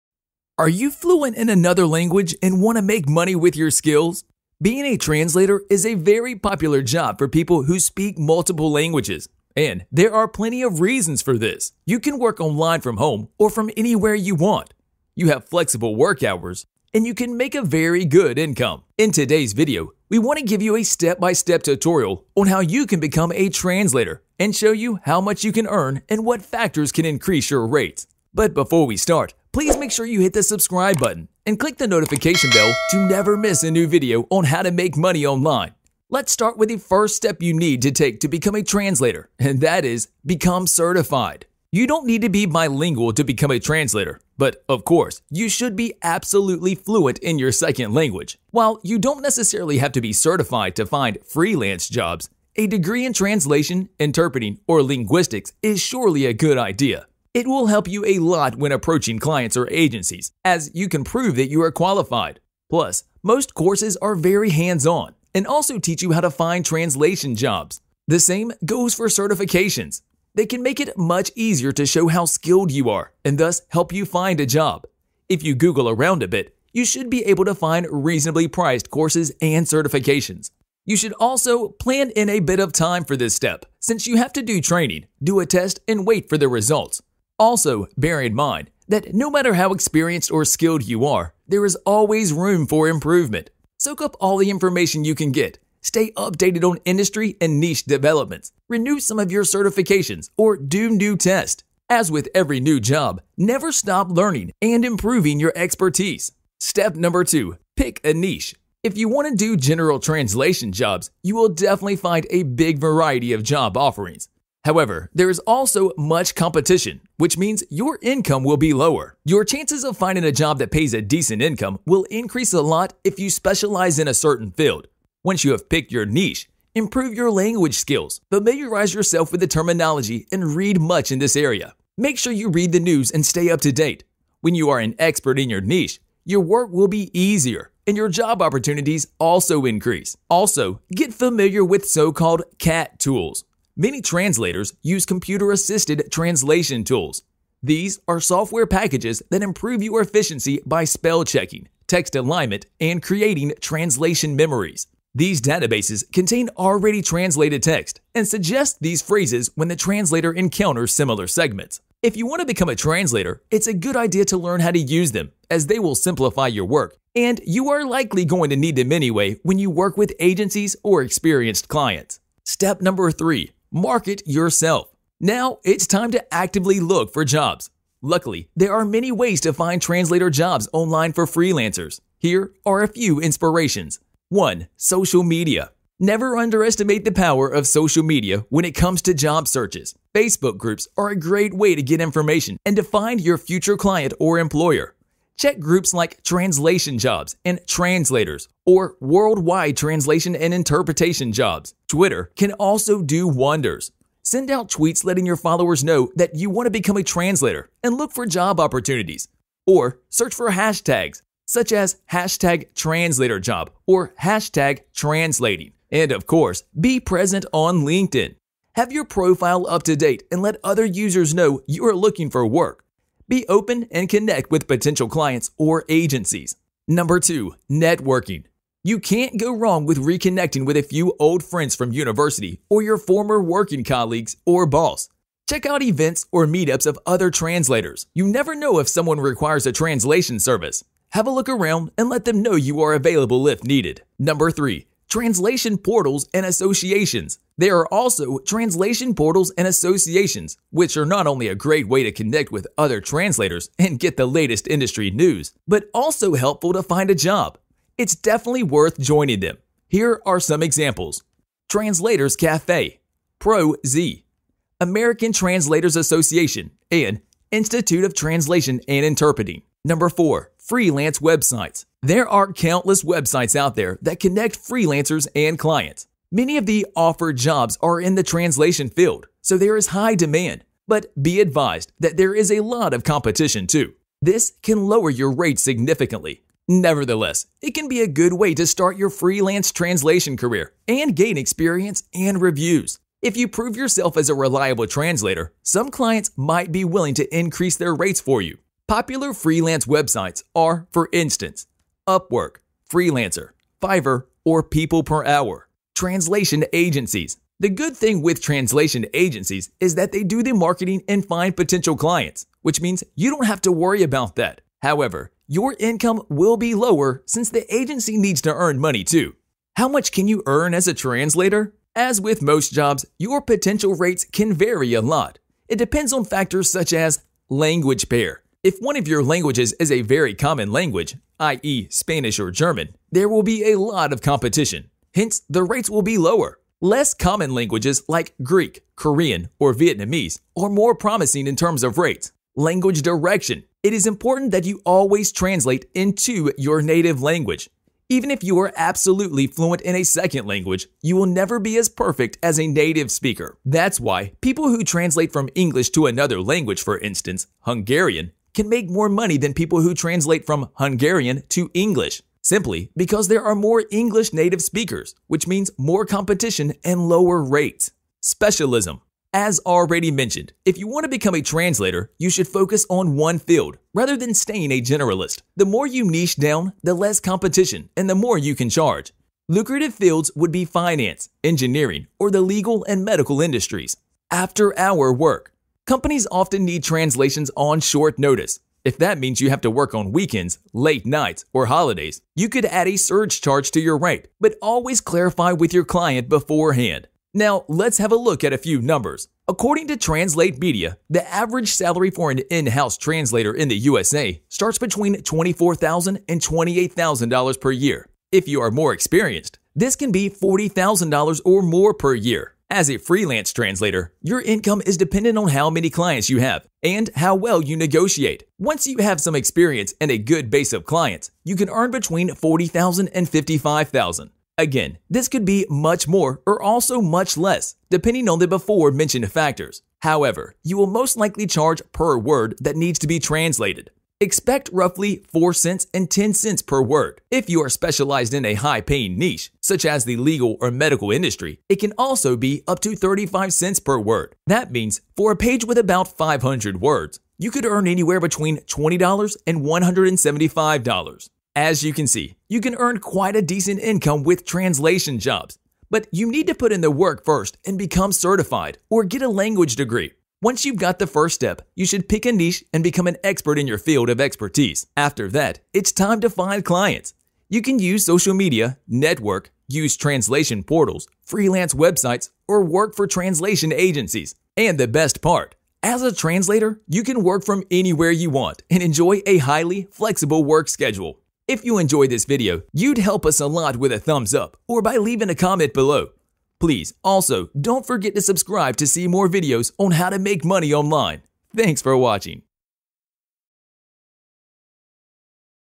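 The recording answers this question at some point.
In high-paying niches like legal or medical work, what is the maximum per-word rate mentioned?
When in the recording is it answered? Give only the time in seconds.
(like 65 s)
442 s.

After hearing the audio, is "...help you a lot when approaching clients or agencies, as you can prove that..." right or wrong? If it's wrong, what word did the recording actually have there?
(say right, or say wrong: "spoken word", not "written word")
right.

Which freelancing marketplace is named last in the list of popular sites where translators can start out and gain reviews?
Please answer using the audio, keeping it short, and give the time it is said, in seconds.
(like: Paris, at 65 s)
People Per Hour, at 304 s.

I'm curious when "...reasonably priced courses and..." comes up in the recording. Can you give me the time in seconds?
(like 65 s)
77 s.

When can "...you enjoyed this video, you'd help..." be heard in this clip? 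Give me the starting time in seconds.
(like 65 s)
481 s.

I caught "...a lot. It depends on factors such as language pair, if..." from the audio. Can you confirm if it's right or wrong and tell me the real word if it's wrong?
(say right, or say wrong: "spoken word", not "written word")
right.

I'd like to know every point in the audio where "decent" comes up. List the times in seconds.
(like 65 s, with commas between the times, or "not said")
121 s, 453 s.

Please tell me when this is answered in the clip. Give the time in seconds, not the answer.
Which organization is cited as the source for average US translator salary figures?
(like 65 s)
399 s.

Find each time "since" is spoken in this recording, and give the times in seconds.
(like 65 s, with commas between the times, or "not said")
83 s, 317 s.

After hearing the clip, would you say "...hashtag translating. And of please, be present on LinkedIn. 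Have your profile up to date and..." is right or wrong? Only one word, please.
wrong.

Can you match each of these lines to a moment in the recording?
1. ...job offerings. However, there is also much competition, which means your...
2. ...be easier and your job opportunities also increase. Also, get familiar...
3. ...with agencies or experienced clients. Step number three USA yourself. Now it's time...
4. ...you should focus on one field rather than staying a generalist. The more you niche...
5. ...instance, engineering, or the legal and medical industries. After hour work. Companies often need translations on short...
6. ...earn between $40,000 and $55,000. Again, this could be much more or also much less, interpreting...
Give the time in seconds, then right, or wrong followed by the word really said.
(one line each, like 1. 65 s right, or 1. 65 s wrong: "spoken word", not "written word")
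1. 113 s right
2. 136 s right
3. 169 s wrong: "Market", not "USA"
4. 372 s right
5. 380 s wrong: "finance", not "instance"
6. 421 s wrong: "depending", not "interpreting".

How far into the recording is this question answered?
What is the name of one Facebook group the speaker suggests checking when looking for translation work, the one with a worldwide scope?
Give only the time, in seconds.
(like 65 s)
198 s.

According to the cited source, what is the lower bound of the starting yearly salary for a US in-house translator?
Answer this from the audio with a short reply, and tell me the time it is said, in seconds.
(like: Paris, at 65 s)
$24,000, at 405 s.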